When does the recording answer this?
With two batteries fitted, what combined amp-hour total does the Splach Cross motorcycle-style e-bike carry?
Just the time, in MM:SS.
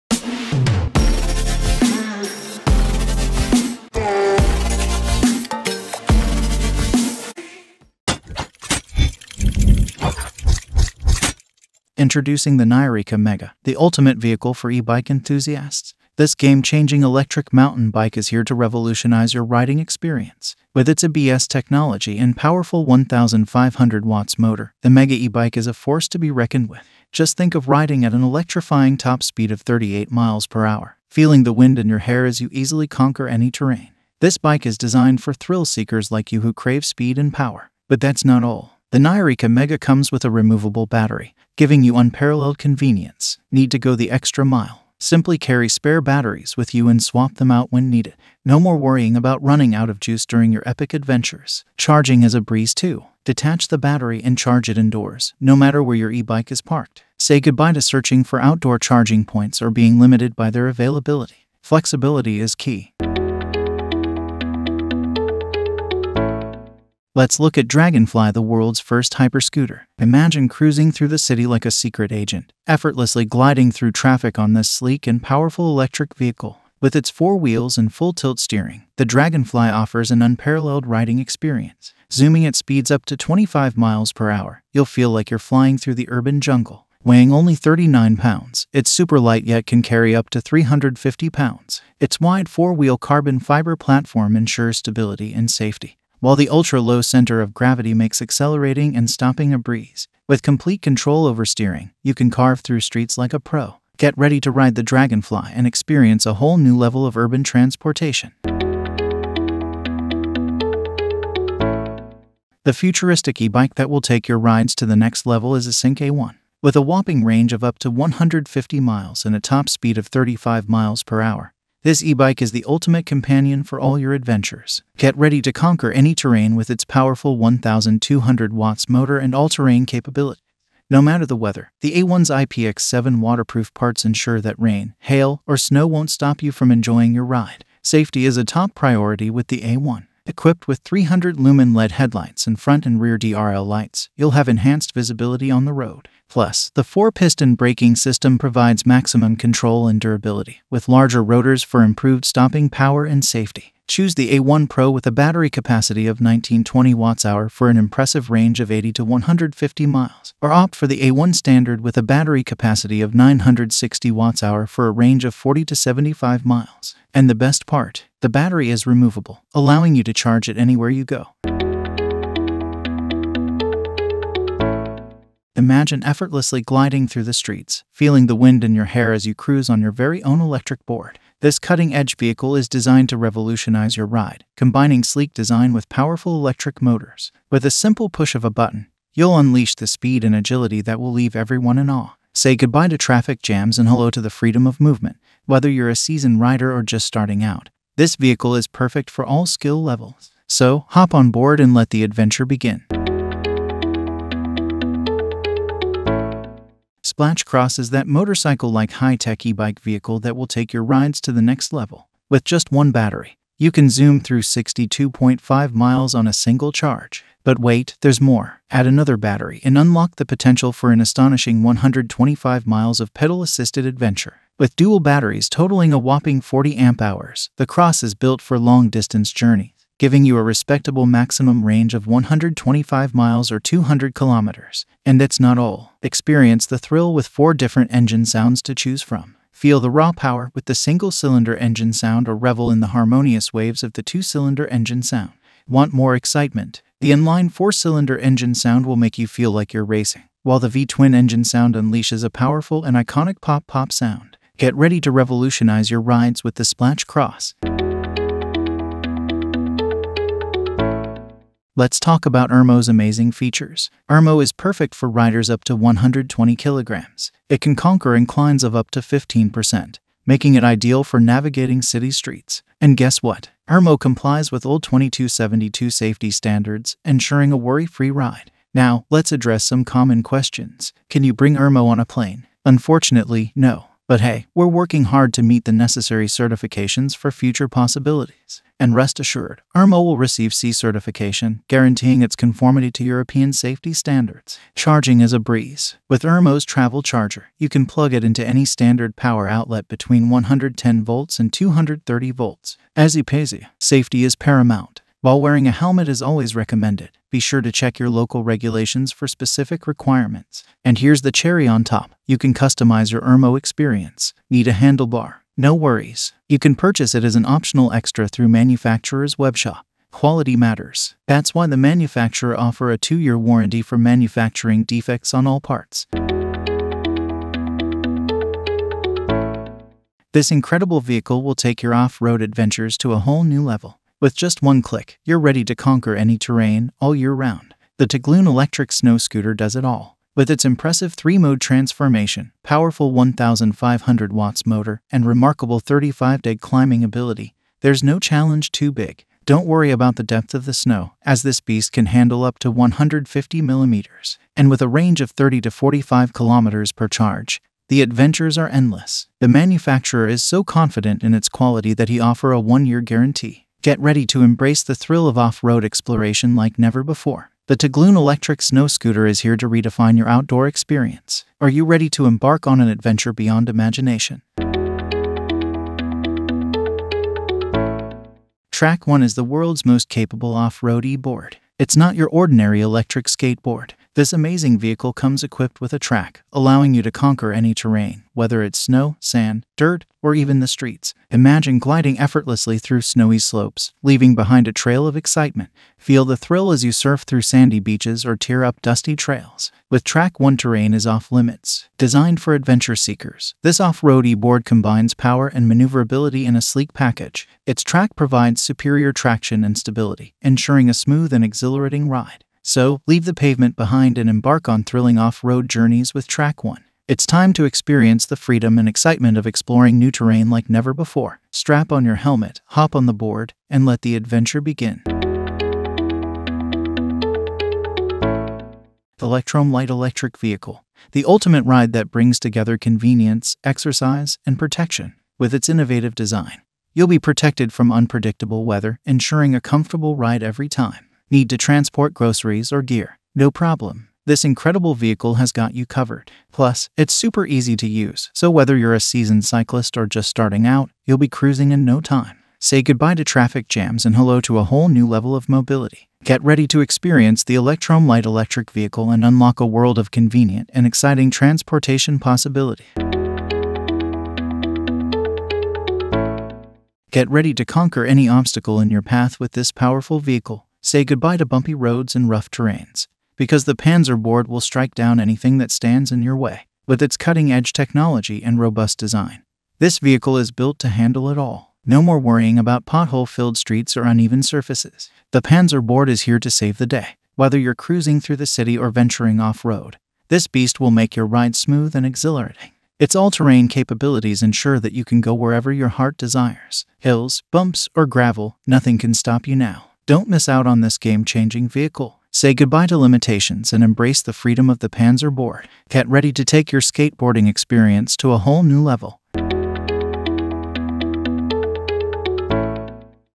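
03:46.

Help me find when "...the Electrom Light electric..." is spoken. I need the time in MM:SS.
07:37.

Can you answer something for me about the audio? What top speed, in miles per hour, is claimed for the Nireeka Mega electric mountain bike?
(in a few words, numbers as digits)
38.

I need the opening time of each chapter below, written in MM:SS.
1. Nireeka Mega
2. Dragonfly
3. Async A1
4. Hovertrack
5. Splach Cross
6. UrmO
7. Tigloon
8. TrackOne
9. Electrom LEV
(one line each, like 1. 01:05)
1. 00:12
2. 01:07
3. 01:52
4. 02:56
5. 03:27
6. 04:21
7. 05:30
8. 06:19
9. 07:09.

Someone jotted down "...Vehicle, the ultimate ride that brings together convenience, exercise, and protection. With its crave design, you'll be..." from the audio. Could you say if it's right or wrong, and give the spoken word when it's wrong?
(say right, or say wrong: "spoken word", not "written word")
wrong: "innovative", not "crave".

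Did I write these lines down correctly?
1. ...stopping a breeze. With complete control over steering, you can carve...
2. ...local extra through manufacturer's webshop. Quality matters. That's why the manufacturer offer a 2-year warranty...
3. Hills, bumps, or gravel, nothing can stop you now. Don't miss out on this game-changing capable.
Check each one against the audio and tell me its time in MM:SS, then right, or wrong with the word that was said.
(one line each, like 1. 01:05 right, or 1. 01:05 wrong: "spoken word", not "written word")
1. 01:39 right
2. 05:17 wrong: "optional", not "local"
3. 08:16 wrong: "vehicle", not "capable".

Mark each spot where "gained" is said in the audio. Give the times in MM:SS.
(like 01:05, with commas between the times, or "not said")
not said.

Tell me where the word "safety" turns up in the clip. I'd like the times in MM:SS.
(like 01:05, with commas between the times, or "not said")
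01:35, 02:17, 02:33, 04:35, 04:53, 05:03.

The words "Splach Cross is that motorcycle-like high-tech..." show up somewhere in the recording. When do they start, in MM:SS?
03:27.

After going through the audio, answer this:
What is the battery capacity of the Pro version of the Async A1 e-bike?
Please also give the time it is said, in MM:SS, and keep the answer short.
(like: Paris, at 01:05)
1920 watt-hours, at 02:36.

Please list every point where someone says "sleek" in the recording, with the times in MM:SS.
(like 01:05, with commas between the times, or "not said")
01:14, 03:05, 06:46.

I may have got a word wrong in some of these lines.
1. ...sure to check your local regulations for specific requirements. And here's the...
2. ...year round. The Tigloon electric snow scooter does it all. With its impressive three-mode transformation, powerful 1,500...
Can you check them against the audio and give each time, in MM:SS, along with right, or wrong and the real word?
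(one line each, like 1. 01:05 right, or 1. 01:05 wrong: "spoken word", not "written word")
1. 05:07 right
2. 05:37 right.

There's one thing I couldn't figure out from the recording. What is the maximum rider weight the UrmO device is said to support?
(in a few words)
120 kilograms.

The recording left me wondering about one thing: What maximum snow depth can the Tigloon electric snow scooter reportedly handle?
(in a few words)
150 millimeters.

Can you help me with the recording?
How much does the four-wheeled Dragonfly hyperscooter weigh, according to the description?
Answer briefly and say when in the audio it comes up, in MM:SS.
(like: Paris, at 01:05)
39 pounds, at 01:27.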